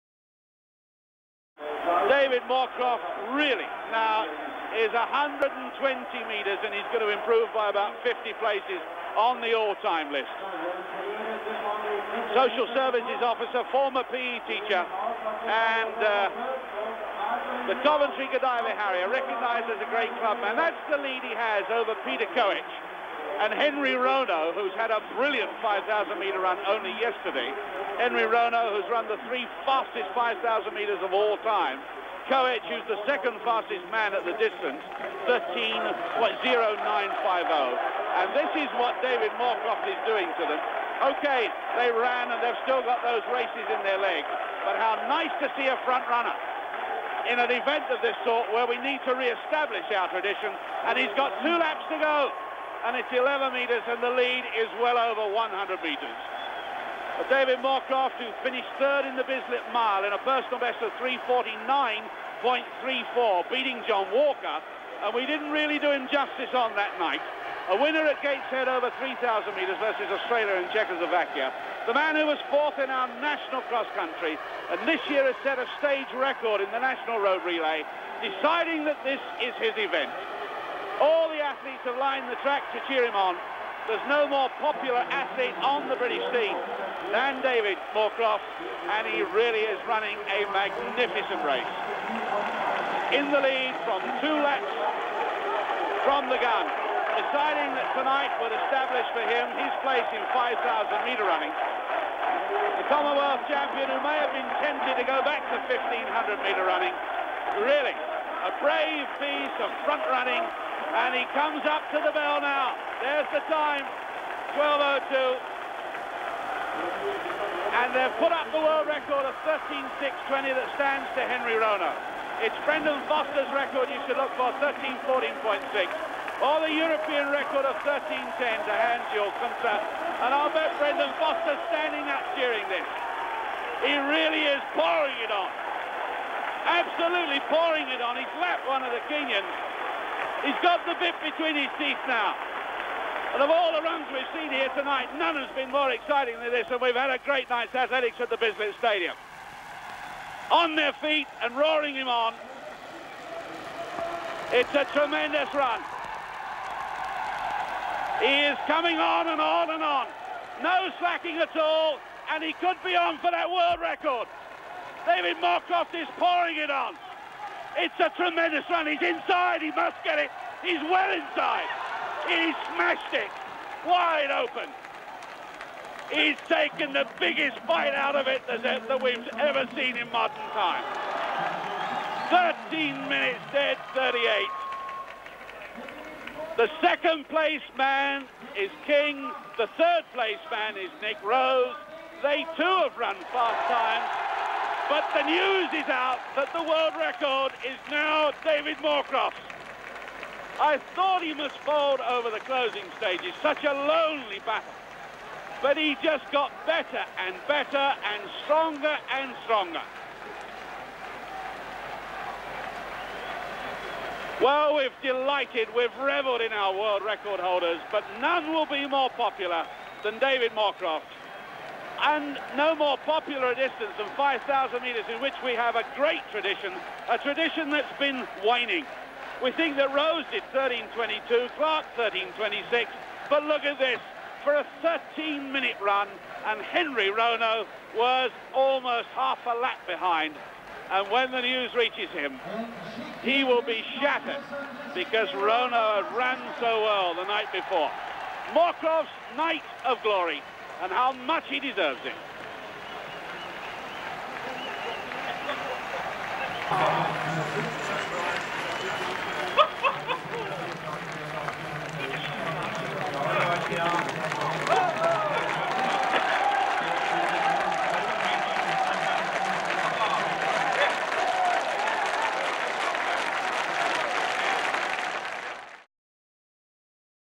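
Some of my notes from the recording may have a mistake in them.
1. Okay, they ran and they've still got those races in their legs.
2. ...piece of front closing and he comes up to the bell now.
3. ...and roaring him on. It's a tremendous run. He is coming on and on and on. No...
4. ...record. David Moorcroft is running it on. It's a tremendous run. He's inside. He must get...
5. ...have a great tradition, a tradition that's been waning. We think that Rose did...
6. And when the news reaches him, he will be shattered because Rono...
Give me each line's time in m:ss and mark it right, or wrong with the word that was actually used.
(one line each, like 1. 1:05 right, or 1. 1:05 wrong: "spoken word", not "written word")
1. 0:41 right
2. 1:49 wrong: "running", not "closing"
3. 2:31 right
4. 2:43 wrong: "pouring", not "running"
5. 3:45 right
6. 4:00 right.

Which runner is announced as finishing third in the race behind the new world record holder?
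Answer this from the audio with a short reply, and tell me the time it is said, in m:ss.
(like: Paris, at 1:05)
Nick Rose, at 3:11.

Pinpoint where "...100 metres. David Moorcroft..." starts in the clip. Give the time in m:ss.
0:55.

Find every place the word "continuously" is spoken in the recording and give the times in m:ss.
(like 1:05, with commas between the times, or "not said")
not said.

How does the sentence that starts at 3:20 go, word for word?
I thought he must fold over the closing stages, such a lonely battle.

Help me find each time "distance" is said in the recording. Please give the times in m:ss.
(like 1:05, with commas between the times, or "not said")
0:34, 3:43.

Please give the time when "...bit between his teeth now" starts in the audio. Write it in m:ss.
2:20.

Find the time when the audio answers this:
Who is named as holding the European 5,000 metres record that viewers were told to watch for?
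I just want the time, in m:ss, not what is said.
2:08.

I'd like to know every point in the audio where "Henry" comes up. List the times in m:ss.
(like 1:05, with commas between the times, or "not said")
0:23, 0:27, 2:01, 3:56.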